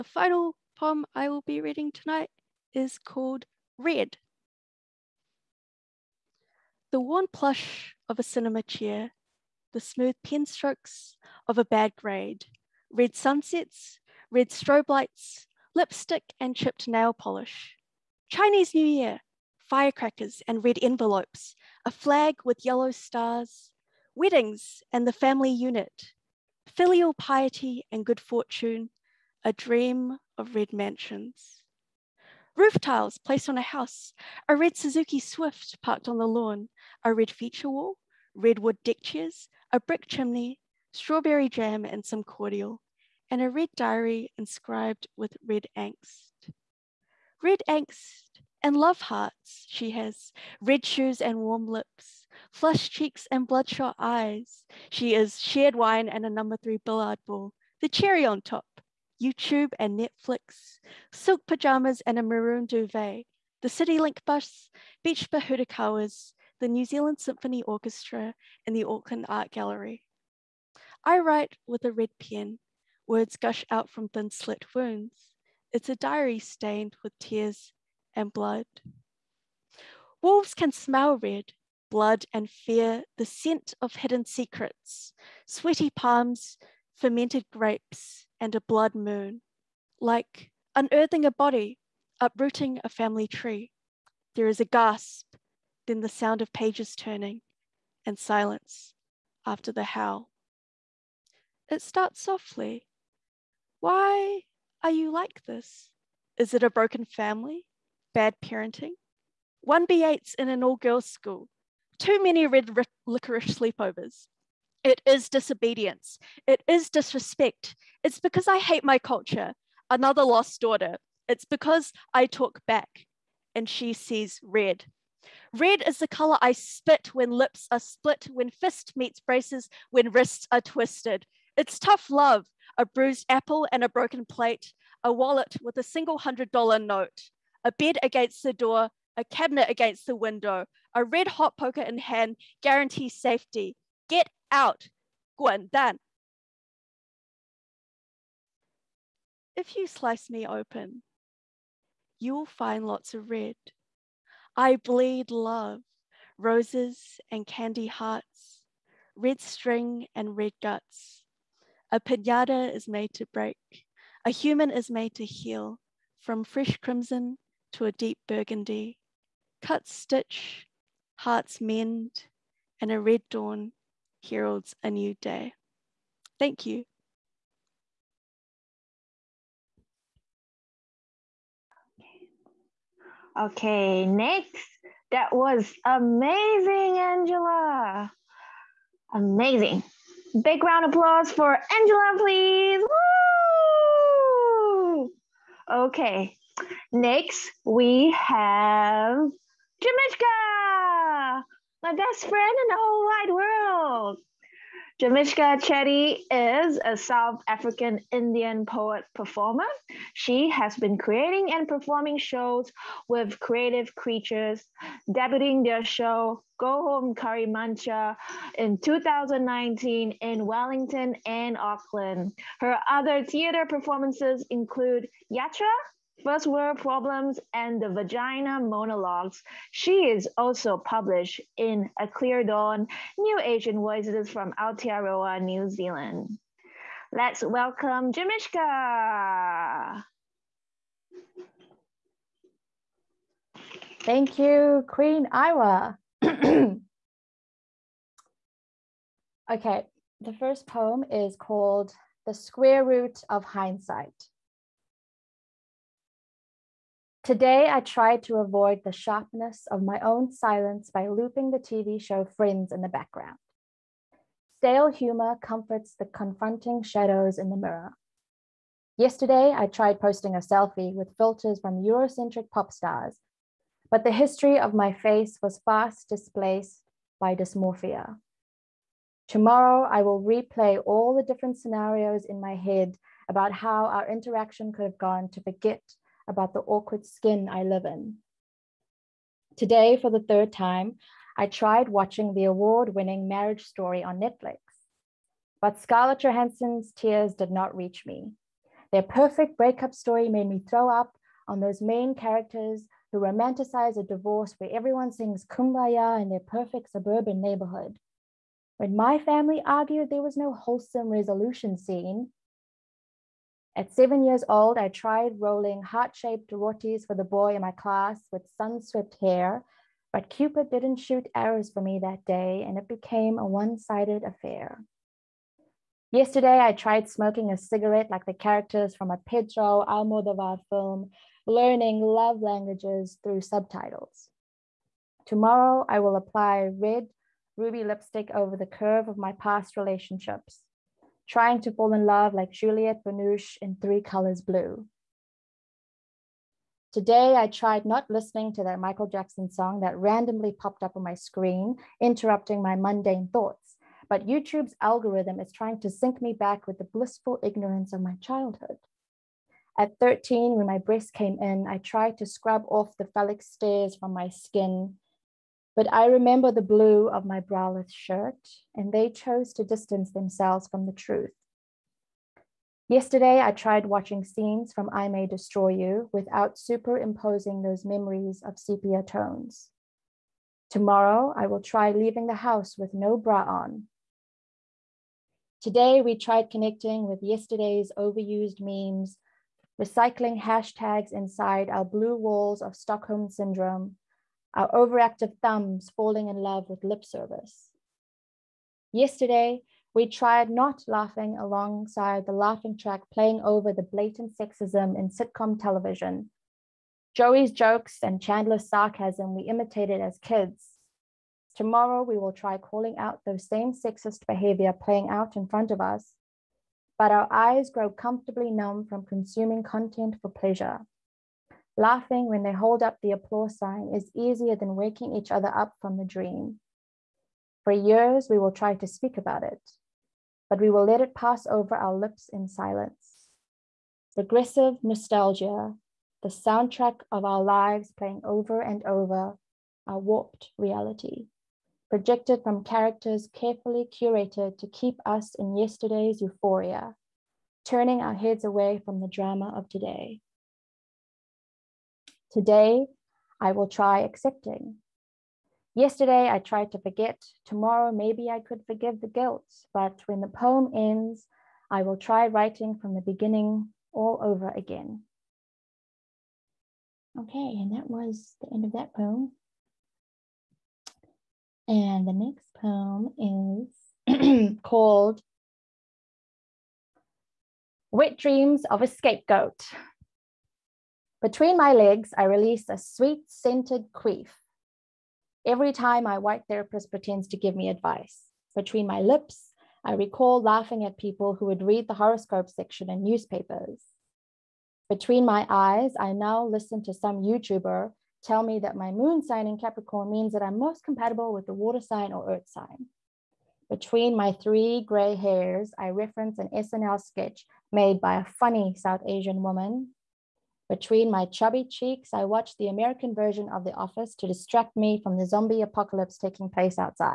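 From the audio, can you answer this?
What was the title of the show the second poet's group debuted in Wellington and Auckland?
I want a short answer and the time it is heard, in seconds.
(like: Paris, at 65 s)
Go Home Curry Muncha, at 216 s.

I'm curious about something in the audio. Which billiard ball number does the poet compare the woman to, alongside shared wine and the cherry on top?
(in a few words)
3.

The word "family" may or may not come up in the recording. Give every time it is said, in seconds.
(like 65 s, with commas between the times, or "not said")
25 s, 92 s, 107 s, 309 s.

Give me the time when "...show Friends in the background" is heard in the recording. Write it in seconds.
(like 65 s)
261 s.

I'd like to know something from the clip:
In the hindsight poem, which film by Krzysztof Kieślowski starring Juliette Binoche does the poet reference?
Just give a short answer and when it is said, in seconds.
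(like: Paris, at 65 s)
Three Colors Blue, at 343 s.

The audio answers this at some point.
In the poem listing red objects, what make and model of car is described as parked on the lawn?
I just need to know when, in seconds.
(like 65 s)
34 s.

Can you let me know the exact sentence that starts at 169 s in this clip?
Cut stitch, hearts mend, and a red dawn heralds a new day.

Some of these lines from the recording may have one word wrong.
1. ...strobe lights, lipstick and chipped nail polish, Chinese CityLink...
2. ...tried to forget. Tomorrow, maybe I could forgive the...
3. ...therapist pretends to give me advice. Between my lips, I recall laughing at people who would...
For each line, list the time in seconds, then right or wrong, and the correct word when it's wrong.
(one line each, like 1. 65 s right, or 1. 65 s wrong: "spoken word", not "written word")
1. 14 s wrong: "New", not "CityLink"
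2. 456 s right
3. 486 s right.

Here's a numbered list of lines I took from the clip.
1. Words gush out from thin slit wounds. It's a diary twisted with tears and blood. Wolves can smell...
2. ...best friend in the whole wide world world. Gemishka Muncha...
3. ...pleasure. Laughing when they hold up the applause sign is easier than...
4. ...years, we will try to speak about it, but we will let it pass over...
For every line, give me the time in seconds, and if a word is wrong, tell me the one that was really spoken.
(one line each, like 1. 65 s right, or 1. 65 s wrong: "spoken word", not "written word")
1. 73 s wrong: "stained", not "twisted"
2. 201 s wrong: "Chetty", not "Muncha"
3. 420 s right
4. 427 s right.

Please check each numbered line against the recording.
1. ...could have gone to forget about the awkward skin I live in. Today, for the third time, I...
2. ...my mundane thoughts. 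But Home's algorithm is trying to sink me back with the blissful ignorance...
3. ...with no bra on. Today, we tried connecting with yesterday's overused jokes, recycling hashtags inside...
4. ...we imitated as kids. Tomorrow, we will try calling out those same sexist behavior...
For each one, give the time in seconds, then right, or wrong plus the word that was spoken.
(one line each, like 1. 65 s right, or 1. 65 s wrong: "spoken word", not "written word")
1. 284 s right
2. 352 s wrong: "YouTube", not "Home"
3. 382 s wrong: "memes", not "jokes"
4. 409 s right.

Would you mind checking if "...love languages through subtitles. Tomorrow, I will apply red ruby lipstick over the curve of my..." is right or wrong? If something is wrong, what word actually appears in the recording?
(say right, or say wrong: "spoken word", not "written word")
right.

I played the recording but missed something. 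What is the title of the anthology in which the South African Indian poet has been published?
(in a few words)
A Clear Dawn.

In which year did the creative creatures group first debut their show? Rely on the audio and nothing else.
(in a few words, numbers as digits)
2019.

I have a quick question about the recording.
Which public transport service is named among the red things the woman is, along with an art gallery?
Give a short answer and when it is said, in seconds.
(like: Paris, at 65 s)
CityLink bus, at 63 s.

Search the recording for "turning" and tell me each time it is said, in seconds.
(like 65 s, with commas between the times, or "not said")
96 s, 447 s.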